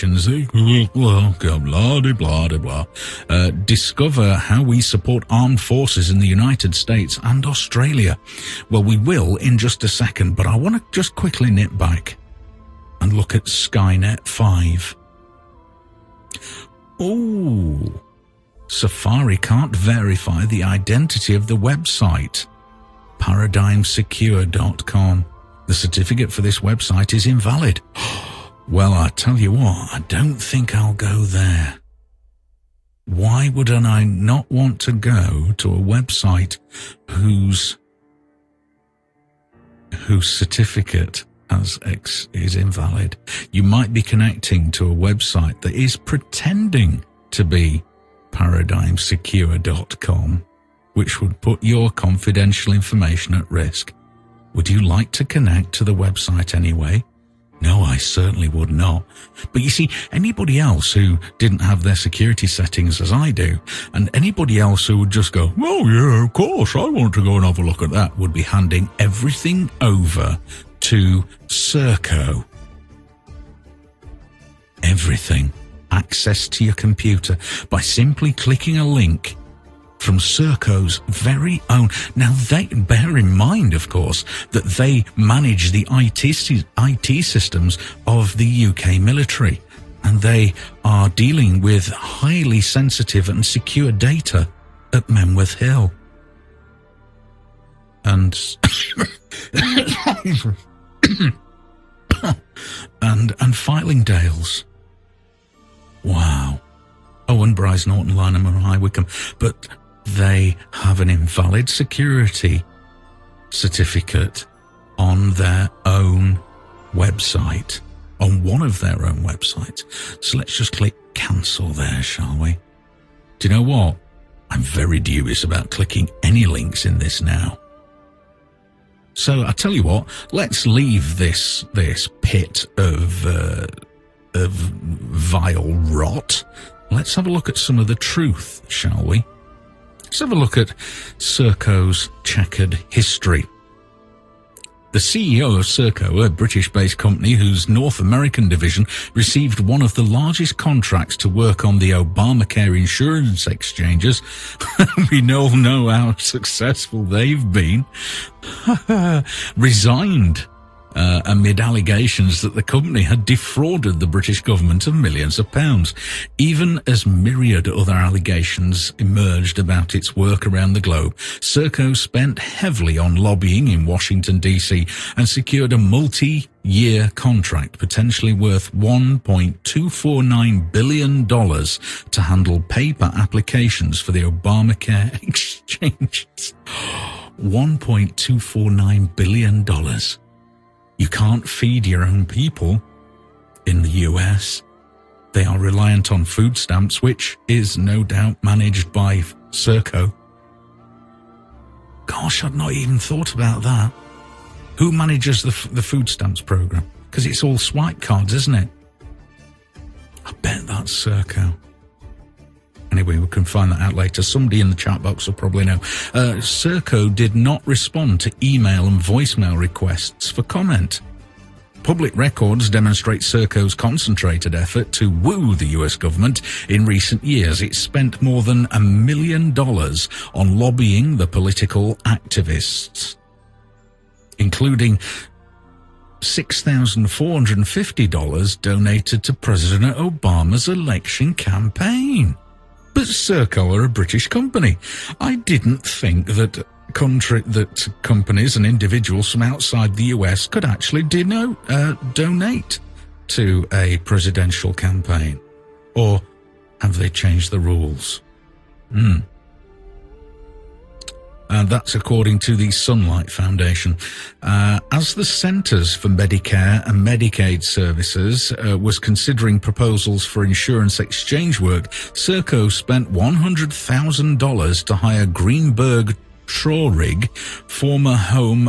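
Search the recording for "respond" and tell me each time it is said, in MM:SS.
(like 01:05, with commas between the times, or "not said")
03:37.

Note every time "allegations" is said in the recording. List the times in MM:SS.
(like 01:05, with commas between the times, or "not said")
02:41, 02:47.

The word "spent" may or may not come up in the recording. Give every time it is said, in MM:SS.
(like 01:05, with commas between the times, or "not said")
02:51, 03:47, 04:32.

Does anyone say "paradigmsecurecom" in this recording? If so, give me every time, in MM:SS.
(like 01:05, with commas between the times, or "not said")
00:23, 00:48.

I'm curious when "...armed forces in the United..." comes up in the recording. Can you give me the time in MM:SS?
00:05.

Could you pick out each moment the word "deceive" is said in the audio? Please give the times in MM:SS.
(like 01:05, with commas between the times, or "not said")
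not said.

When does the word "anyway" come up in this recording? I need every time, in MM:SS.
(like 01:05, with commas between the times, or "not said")
00:56, 03:32.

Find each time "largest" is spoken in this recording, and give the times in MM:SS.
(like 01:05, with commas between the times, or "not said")
02:30.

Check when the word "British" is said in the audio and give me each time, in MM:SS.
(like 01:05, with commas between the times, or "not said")
02:26, 02:44, 04:03.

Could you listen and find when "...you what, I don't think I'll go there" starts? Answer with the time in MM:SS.
00:29.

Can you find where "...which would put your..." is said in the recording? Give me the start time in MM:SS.
00:50.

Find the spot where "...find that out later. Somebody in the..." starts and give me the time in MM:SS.
03:33.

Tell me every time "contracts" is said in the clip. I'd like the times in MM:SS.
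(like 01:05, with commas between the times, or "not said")
02:30, 02:57.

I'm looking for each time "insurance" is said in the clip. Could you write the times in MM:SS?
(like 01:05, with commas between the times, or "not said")
02:32, 04:30.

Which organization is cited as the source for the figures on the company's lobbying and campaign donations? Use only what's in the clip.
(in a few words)
Sunlight Foundation.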